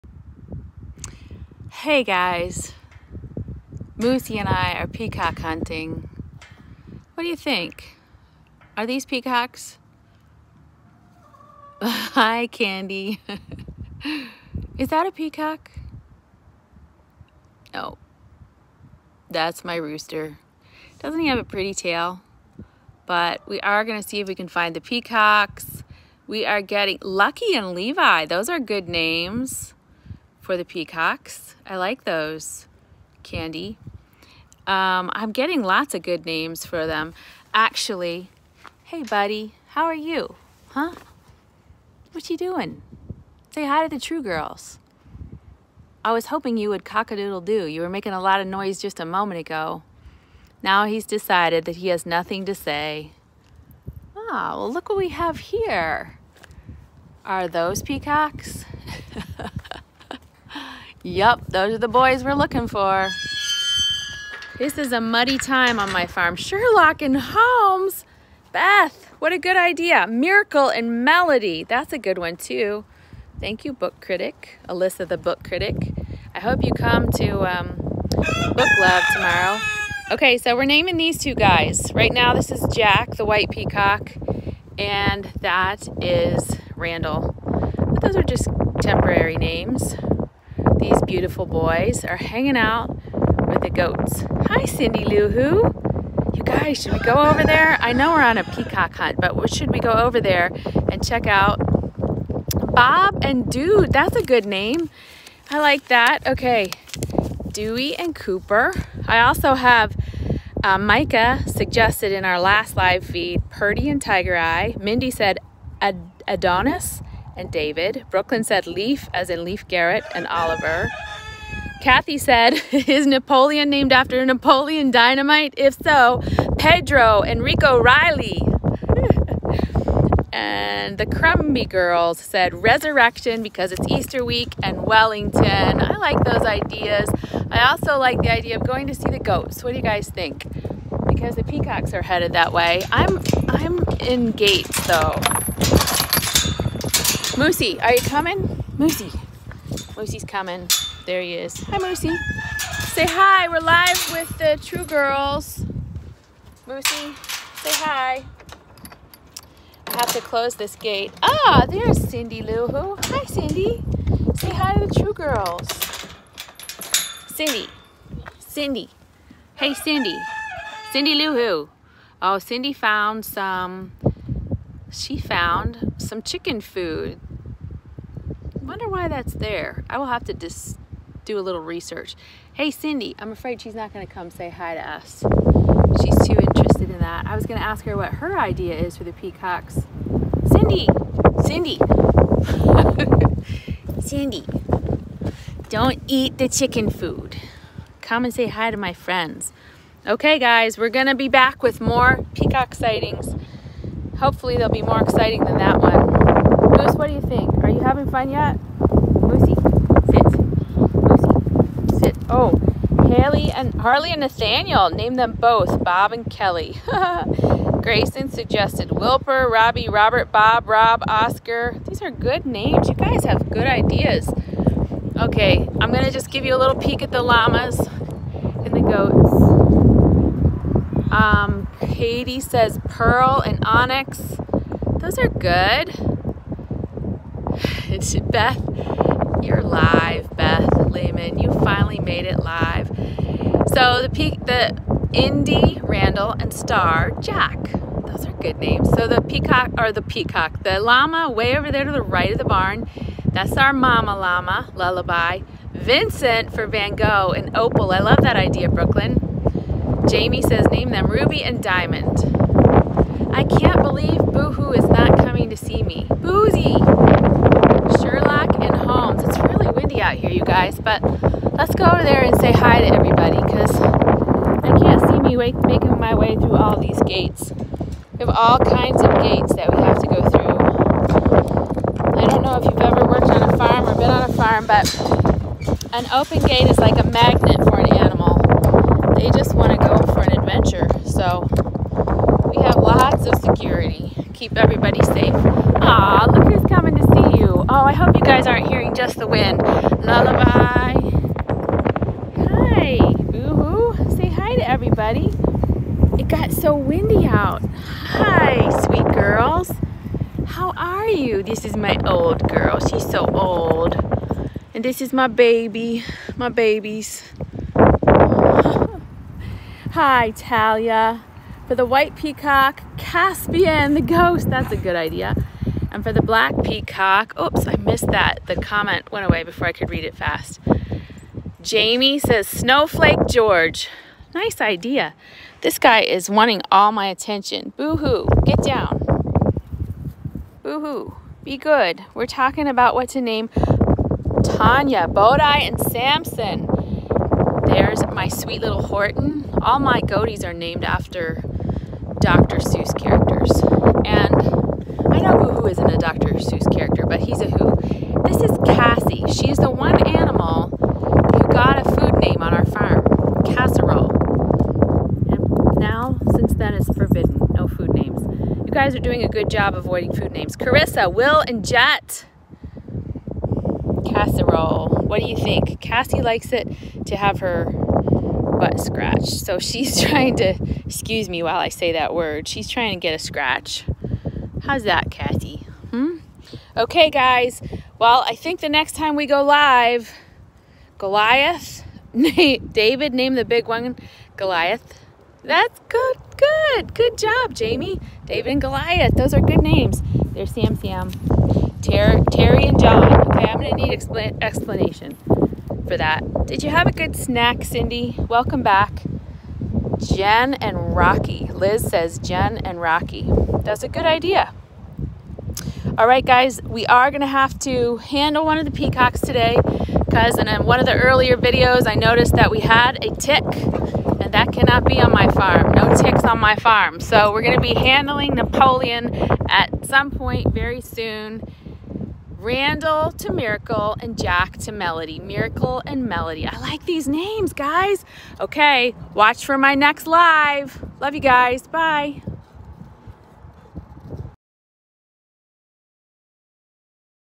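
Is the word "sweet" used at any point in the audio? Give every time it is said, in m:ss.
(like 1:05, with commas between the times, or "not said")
5:08, 5:48.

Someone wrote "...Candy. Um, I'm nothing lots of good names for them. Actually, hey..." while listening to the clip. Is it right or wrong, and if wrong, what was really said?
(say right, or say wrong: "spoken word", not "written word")
wrong: "getting", not "nothing".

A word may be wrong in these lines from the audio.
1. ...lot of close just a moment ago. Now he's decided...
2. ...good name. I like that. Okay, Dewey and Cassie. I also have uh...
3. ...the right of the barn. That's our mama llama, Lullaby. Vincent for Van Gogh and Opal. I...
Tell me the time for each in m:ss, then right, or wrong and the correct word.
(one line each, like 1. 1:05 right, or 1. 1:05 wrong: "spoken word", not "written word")
1. 0:48 wrong: "noise", not "close"
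2. 1:44 wrong: "Cooper", not "Cassie"
3. 4:11 right.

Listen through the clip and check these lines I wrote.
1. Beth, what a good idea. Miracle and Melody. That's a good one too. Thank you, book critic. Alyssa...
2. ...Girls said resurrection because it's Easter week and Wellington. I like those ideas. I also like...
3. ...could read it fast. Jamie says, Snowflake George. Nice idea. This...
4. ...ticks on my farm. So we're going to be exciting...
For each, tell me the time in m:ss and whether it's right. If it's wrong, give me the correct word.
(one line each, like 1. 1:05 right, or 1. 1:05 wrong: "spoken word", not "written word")
1. 1:08 right
2. 2:11 right
3. 5:29 right
4. 7:05 wrong: "handling", not "exciting".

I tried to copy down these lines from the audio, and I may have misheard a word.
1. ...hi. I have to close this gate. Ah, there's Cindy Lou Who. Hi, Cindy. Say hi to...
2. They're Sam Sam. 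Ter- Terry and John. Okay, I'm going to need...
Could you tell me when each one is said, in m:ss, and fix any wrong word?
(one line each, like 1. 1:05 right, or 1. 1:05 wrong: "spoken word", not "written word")
1. 2:37 right
2. 6:40 right.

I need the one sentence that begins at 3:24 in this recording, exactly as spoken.
Hopefully, they'll be more exciting than that one.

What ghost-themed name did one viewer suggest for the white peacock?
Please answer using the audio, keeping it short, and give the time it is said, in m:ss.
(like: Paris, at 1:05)
Caspian the ghost, at 5:22.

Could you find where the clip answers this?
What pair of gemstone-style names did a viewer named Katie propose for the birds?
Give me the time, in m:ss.
3:52.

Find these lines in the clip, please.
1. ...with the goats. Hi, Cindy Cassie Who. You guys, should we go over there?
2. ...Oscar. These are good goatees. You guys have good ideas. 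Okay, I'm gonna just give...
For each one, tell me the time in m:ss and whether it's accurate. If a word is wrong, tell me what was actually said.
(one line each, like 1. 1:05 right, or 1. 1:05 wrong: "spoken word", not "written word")
1. 1:33 wrong: "Lou", not "Cassie"
2. 3:41 wrong: "names", not "goatees".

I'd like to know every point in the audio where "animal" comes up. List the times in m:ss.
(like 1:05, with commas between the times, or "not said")
4:47, 6:00.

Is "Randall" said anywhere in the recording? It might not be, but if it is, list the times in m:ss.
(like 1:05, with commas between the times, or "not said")
1:26, 4:05, 7:12.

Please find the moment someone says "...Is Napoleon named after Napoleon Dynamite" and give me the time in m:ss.
2:02.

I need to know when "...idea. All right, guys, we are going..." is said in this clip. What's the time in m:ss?
6:54.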